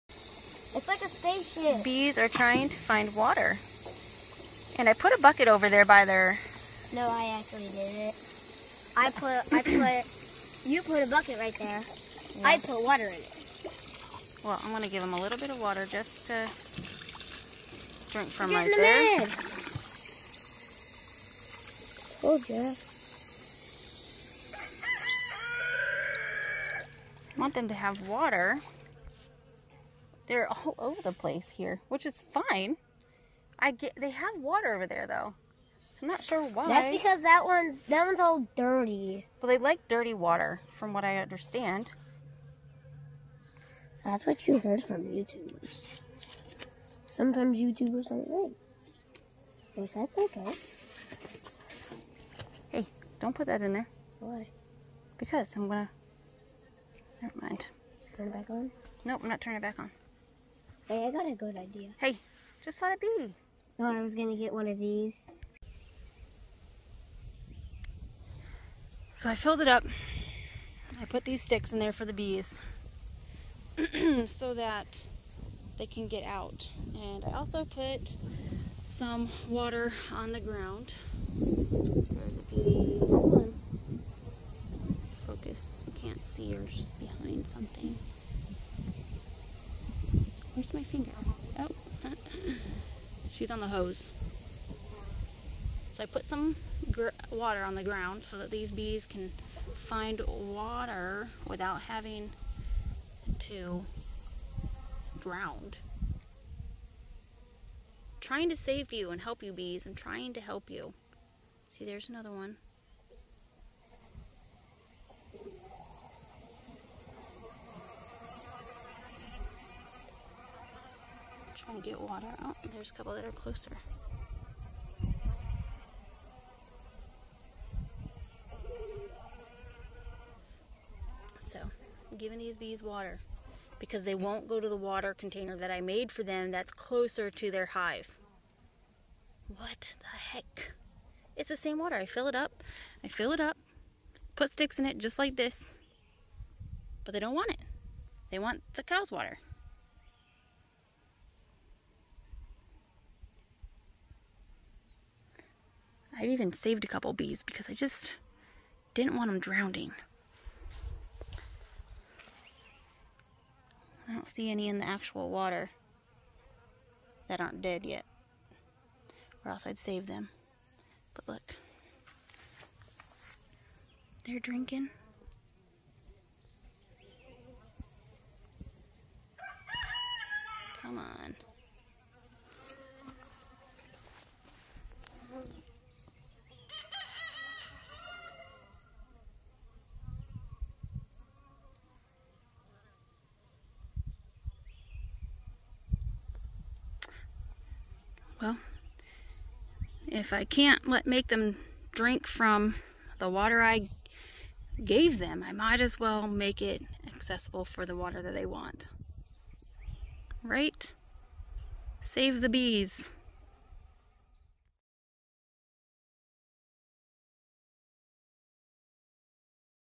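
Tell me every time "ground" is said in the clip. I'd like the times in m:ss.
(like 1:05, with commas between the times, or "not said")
1:20, 1:37.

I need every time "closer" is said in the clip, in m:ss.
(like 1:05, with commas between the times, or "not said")
2:03, 2:16.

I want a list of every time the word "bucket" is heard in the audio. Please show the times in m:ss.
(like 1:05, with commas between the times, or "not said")
0:05, 0:11.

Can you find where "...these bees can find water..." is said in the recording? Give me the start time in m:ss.
1:38.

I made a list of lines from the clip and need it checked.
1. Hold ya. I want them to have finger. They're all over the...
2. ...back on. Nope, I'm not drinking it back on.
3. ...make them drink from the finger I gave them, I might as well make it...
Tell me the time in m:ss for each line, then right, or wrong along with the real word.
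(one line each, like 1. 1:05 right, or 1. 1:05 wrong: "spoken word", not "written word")
1. 0:22 wrong: "water", not "finger"
2. 0:58 wrong: "turning", not "drinking"
3. 3:21 wrong: "water", not "finger".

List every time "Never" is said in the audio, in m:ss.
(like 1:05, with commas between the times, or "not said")
0:57.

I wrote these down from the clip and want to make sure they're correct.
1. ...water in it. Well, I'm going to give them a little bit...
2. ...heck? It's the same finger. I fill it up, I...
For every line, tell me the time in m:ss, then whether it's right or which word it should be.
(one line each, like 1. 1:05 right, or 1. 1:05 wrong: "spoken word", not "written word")
1. 0:12 right
2. 2:20 wrong: "water", not "finger".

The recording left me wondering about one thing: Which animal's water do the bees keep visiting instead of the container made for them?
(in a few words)
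The cow's.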